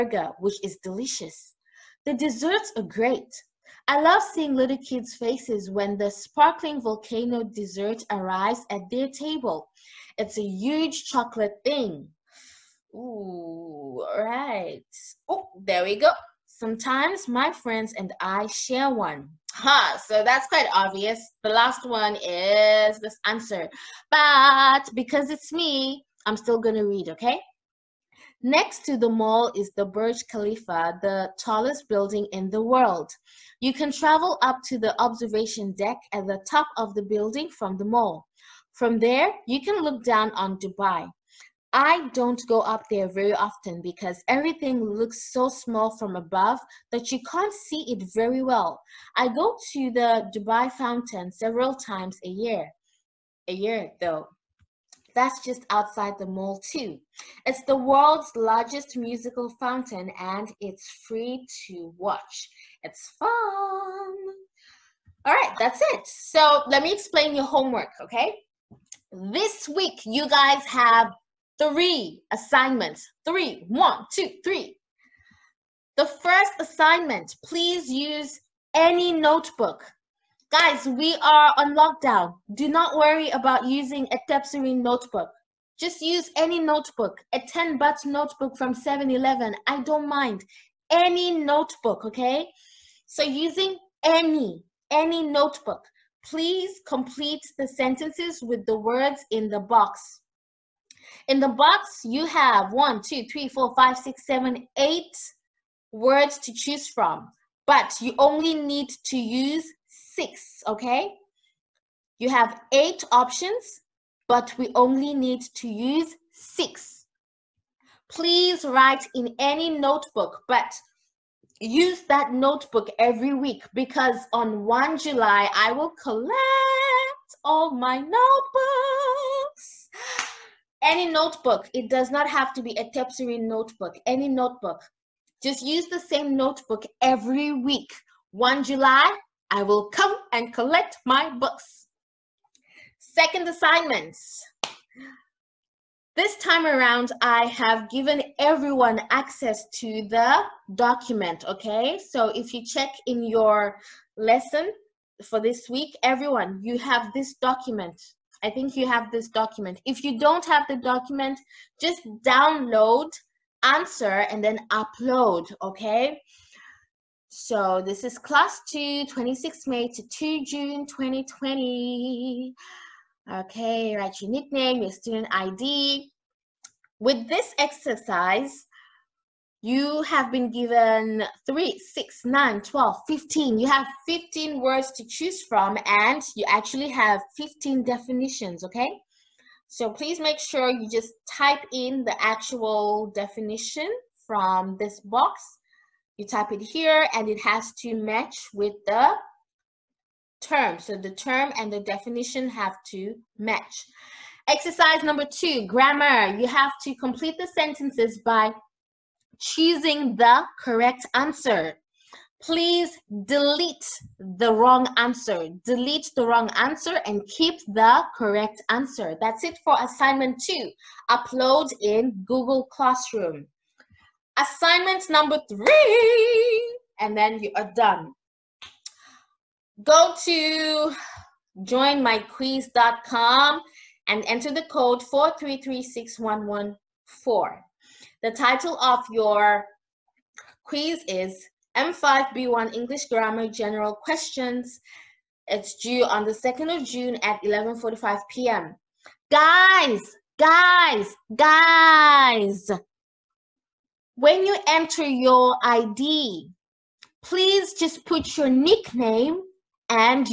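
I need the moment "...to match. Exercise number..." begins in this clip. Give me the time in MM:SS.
03:22.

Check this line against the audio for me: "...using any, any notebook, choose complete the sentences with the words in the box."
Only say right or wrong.
wrong.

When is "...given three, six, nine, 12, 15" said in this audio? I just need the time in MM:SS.
03:00.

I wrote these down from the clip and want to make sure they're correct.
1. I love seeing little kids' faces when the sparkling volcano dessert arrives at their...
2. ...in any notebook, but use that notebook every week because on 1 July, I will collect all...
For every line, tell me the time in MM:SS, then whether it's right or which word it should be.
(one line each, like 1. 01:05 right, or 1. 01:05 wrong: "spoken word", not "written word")
1. 00:03 right
2. 01:59 right.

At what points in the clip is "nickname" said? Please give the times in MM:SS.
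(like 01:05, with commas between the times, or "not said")
02:54, 04:18.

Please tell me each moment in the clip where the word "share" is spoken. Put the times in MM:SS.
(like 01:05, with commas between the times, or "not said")
00:18.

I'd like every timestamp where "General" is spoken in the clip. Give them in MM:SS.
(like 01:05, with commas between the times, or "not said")
04:03.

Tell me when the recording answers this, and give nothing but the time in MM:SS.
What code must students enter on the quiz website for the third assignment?
03:55.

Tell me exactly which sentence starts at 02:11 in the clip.
It does not have to be a Tepsiri notebook, any notebook.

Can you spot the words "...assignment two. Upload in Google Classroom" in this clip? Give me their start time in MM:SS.
03:39.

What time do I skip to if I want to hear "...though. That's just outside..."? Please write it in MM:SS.
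00:54.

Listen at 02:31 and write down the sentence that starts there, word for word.
So if you check in your lesson for this week, everyone, you have this document I think you have this document.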